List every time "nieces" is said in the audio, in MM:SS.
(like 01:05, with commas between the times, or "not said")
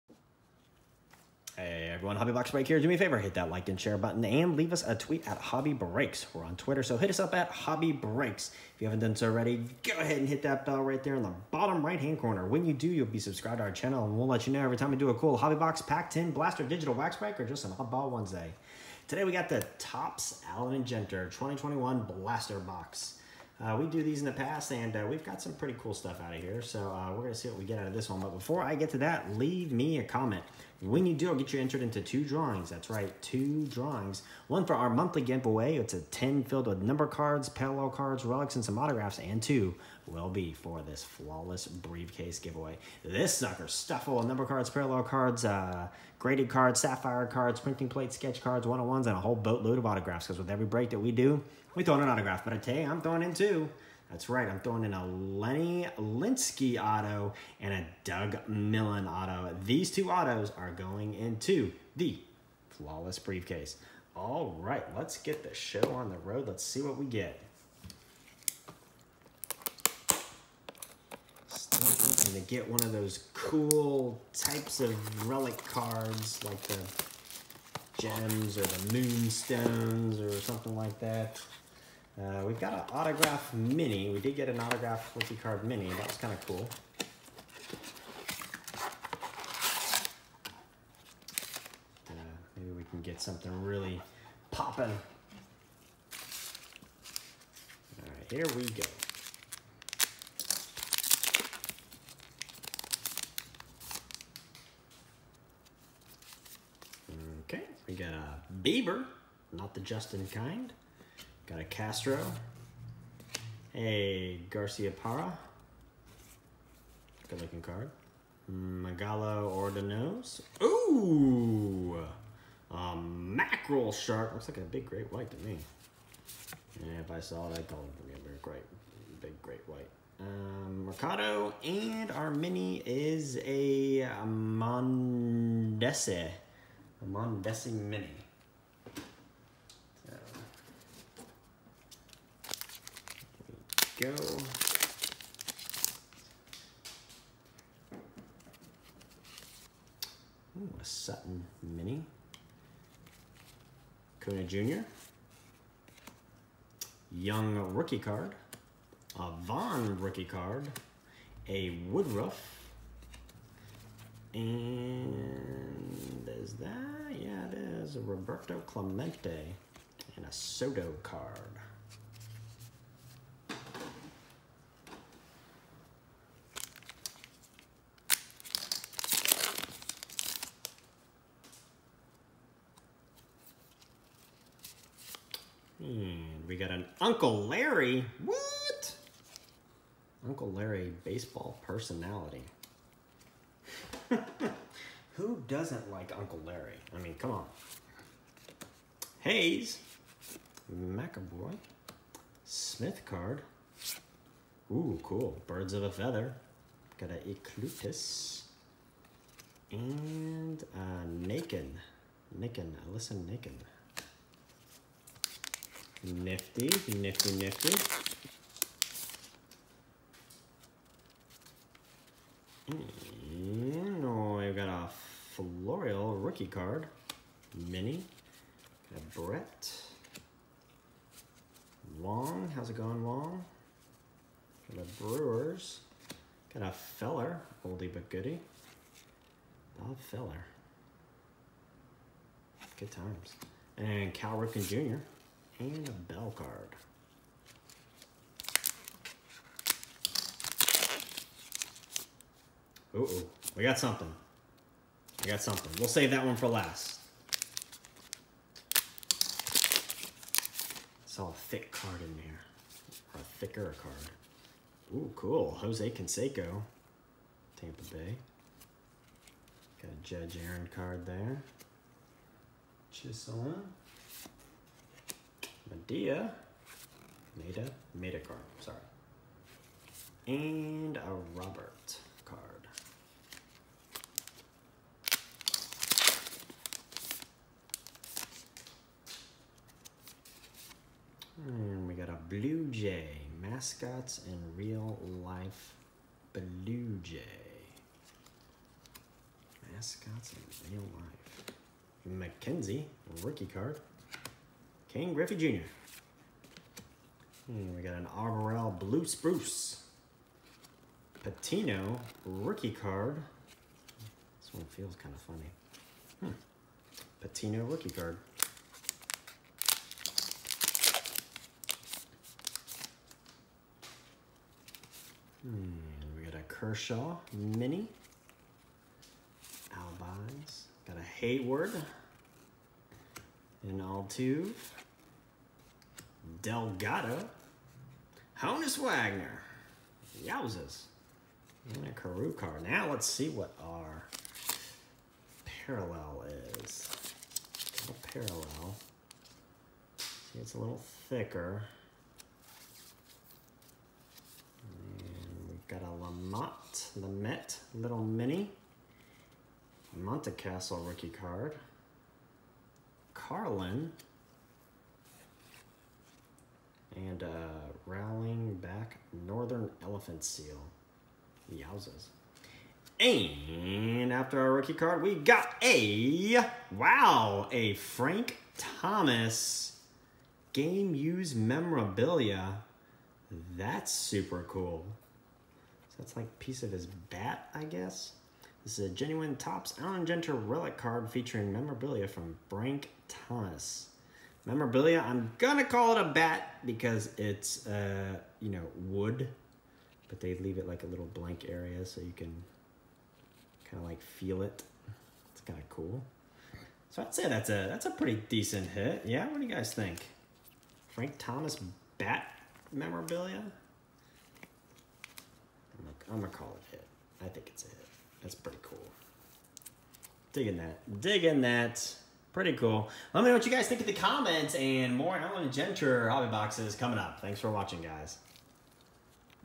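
not said.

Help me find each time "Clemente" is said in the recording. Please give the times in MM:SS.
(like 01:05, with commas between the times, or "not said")
02:48.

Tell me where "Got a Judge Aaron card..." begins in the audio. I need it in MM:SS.
04:29.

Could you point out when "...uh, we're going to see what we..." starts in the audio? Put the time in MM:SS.
00:26.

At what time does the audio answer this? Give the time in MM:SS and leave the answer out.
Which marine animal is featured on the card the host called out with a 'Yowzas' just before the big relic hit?
06:09.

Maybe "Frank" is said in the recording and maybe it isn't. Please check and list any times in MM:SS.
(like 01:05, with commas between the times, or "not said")
06:17, 06:32, 06:50.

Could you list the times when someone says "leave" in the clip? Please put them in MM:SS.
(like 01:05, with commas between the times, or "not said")
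00:04, 00:29, 06:40.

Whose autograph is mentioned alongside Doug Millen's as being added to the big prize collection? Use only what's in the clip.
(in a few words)
Lenny Linsky.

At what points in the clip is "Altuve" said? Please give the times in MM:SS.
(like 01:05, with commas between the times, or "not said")
05:33.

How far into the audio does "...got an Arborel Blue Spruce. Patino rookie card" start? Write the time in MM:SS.
05:07.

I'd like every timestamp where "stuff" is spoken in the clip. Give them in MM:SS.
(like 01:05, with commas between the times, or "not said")
00:25, 00:43.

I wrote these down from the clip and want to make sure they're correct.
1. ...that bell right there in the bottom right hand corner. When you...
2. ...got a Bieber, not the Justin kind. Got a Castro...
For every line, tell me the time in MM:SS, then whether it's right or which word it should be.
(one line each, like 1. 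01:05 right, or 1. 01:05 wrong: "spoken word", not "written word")
1. 00:10 right
2. 01:47 right.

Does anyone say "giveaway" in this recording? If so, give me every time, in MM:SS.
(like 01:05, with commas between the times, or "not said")
00:35, 00:42.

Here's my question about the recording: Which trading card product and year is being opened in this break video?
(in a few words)
Topps Allen and Ginter 2021.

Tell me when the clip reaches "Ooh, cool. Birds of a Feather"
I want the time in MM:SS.
03:24.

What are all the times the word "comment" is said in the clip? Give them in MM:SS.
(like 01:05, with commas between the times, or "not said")
00:30, 07:03.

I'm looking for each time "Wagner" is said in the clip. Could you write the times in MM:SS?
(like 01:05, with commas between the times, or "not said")
05:38.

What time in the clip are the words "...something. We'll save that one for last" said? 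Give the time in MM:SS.
04:15.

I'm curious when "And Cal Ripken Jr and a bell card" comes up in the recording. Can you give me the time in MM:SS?
04:03.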